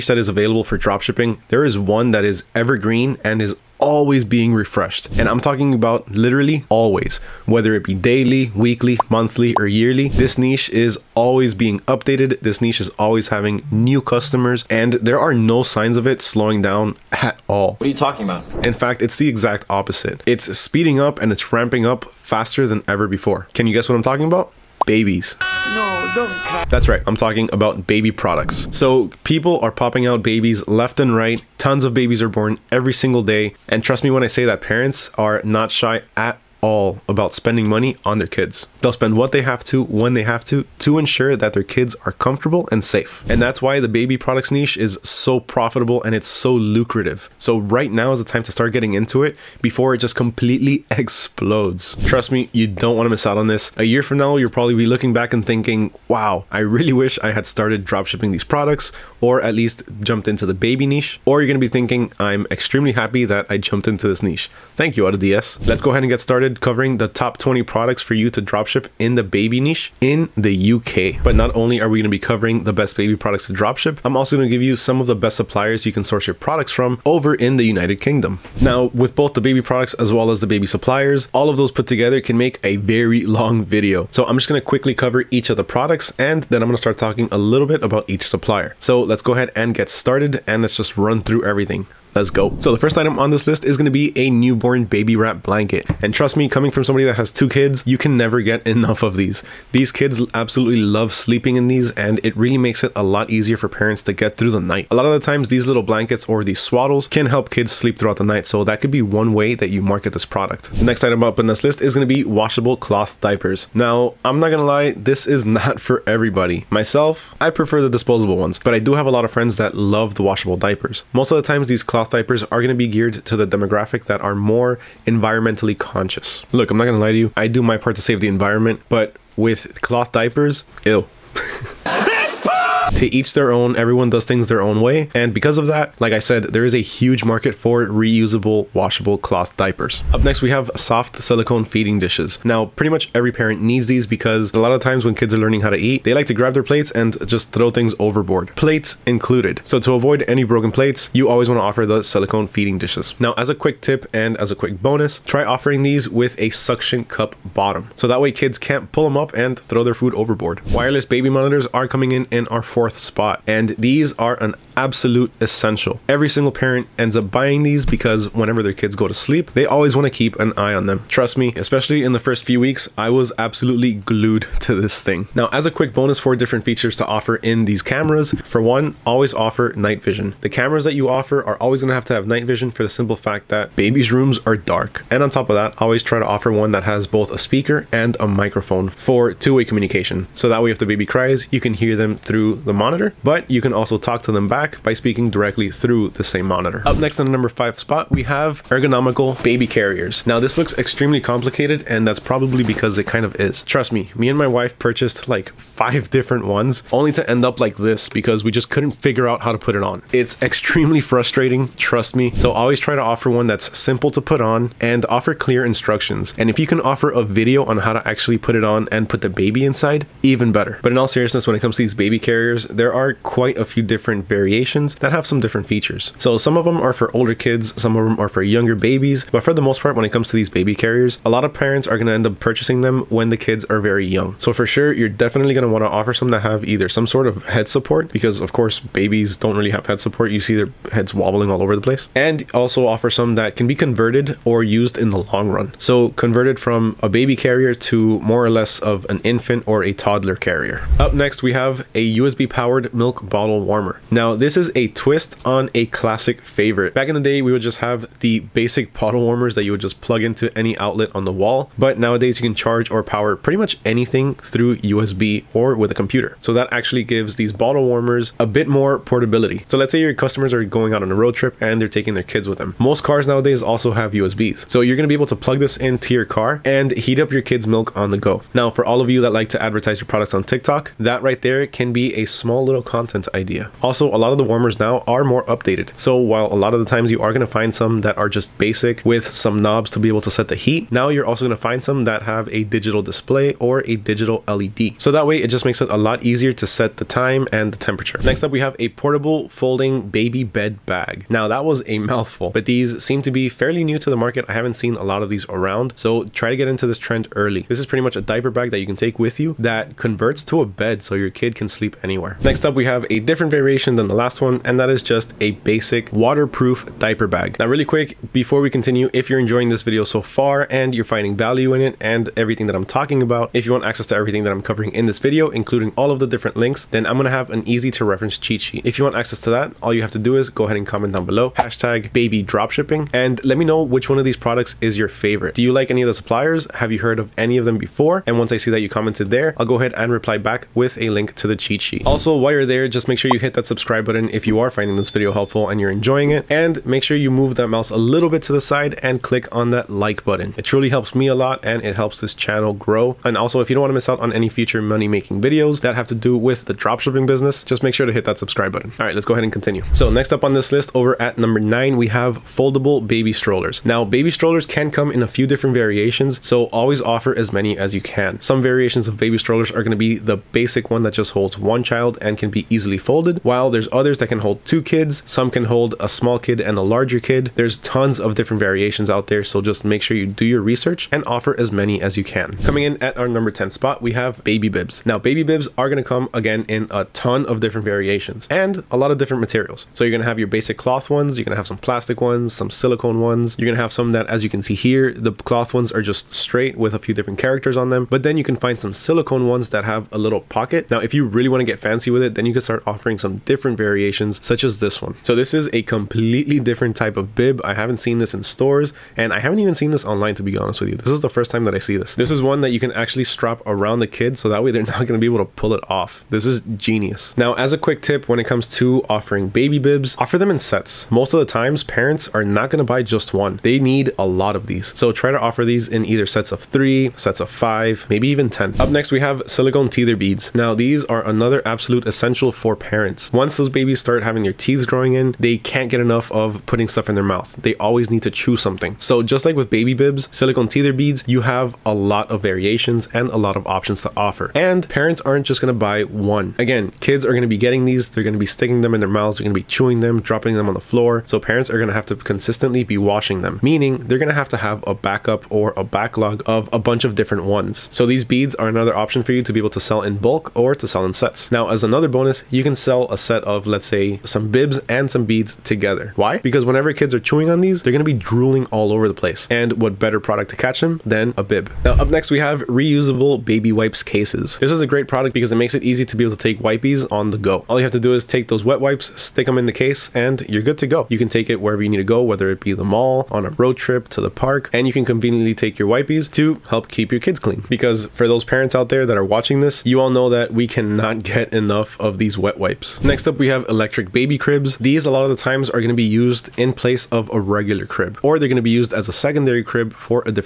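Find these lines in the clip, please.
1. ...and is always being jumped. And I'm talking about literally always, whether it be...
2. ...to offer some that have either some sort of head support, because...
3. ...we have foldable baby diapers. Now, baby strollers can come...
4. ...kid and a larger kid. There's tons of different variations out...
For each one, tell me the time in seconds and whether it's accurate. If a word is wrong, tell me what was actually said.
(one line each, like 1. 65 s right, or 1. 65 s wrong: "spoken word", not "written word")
1. 3 s wrong: "refreshed", not "jumped"
2. 235 s right
3. 361 s wrong: "strollers", not "diapers"
4. 376 s right.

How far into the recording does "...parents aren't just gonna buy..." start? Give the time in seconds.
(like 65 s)
444 s.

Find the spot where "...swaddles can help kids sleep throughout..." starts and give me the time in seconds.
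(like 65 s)
106 s.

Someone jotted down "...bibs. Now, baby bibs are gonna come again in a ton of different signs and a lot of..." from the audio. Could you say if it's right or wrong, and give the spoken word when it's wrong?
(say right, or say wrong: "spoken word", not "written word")
wrong: "variations", not "signs".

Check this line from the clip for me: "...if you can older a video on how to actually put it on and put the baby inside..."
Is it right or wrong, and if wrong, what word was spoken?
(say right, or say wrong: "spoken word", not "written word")
wrong: "offer", not "older".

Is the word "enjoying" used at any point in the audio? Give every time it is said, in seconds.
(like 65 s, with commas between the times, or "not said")
319 s, 345 s.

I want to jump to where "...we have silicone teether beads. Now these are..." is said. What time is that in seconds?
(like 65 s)
429 s.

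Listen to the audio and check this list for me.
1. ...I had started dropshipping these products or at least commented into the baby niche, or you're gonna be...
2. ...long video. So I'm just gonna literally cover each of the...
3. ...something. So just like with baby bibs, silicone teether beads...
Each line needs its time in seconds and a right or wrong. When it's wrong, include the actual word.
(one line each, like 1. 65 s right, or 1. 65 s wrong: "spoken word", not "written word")
1. 57 s wrong: "jumped", not "commented"
2. 83 s wrong: "quickly", not "literally"
3. 438 s right.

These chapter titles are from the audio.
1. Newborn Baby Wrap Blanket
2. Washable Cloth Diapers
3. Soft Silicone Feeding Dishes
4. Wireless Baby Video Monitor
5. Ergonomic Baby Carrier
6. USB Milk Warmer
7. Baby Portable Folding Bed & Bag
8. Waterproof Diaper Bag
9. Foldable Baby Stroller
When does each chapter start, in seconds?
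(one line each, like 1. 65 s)
1. 92 s
2. 111 s
3. 140 s
4. 160 s
5. 196 s
6. 251 s
7. 298 s
8. 312 s
9. 360 s.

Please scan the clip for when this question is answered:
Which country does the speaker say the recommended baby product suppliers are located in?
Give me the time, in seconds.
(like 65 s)
77 s.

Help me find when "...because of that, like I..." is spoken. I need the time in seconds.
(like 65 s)
135 s.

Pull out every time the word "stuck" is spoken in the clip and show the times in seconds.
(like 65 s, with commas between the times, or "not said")
not said.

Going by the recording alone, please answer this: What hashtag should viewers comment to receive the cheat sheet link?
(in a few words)
baby dropshipping.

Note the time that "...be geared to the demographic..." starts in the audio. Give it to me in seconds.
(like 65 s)
122 s.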